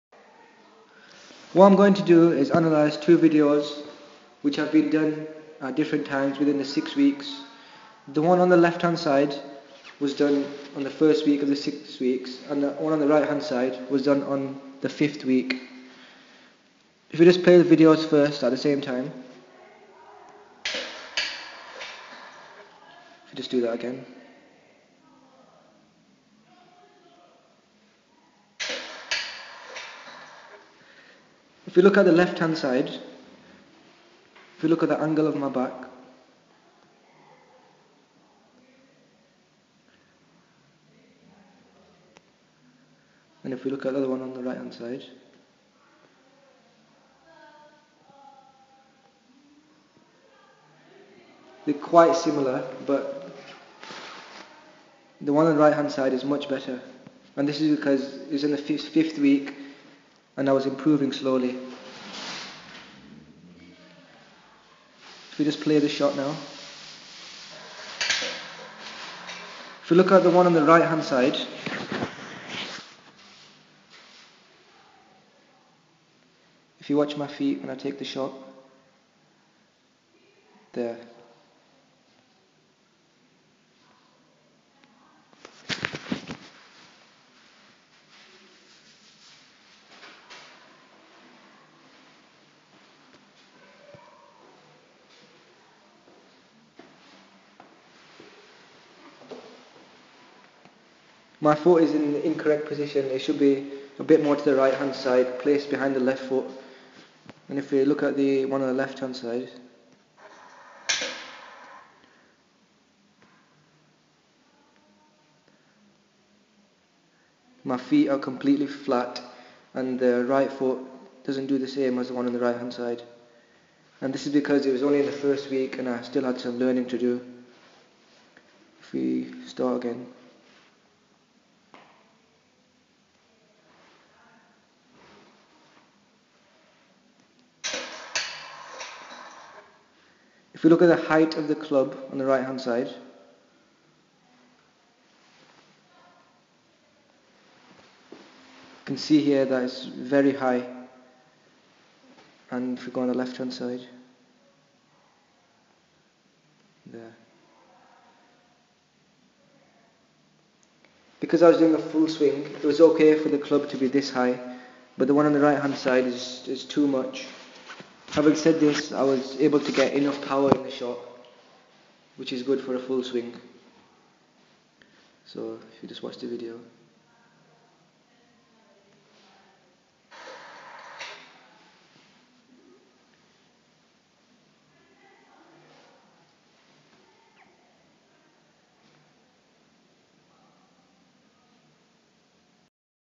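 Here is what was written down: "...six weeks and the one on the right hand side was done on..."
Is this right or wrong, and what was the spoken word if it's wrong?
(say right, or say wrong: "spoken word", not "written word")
right.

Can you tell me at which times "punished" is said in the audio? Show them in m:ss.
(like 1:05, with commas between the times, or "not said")
not said.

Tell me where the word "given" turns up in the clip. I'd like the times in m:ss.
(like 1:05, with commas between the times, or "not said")
not said.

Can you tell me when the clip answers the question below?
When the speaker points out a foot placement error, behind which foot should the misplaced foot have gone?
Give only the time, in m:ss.
1:45.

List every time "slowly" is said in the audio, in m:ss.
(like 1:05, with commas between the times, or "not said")
1:01.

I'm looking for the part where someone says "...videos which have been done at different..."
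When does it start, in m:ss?
0:03.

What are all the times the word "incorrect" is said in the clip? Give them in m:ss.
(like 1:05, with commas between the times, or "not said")
1:42.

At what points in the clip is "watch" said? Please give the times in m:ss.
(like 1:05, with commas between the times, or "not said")
1:16, 2:56.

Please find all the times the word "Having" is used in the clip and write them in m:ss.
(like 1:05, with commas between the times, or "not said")
2:48.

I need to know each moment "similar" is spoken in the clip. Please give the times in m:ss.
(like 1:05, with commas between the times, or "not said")
0:52.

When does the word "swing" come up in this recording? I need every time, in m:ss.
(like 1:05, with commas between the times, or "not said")
2:42, 2:53.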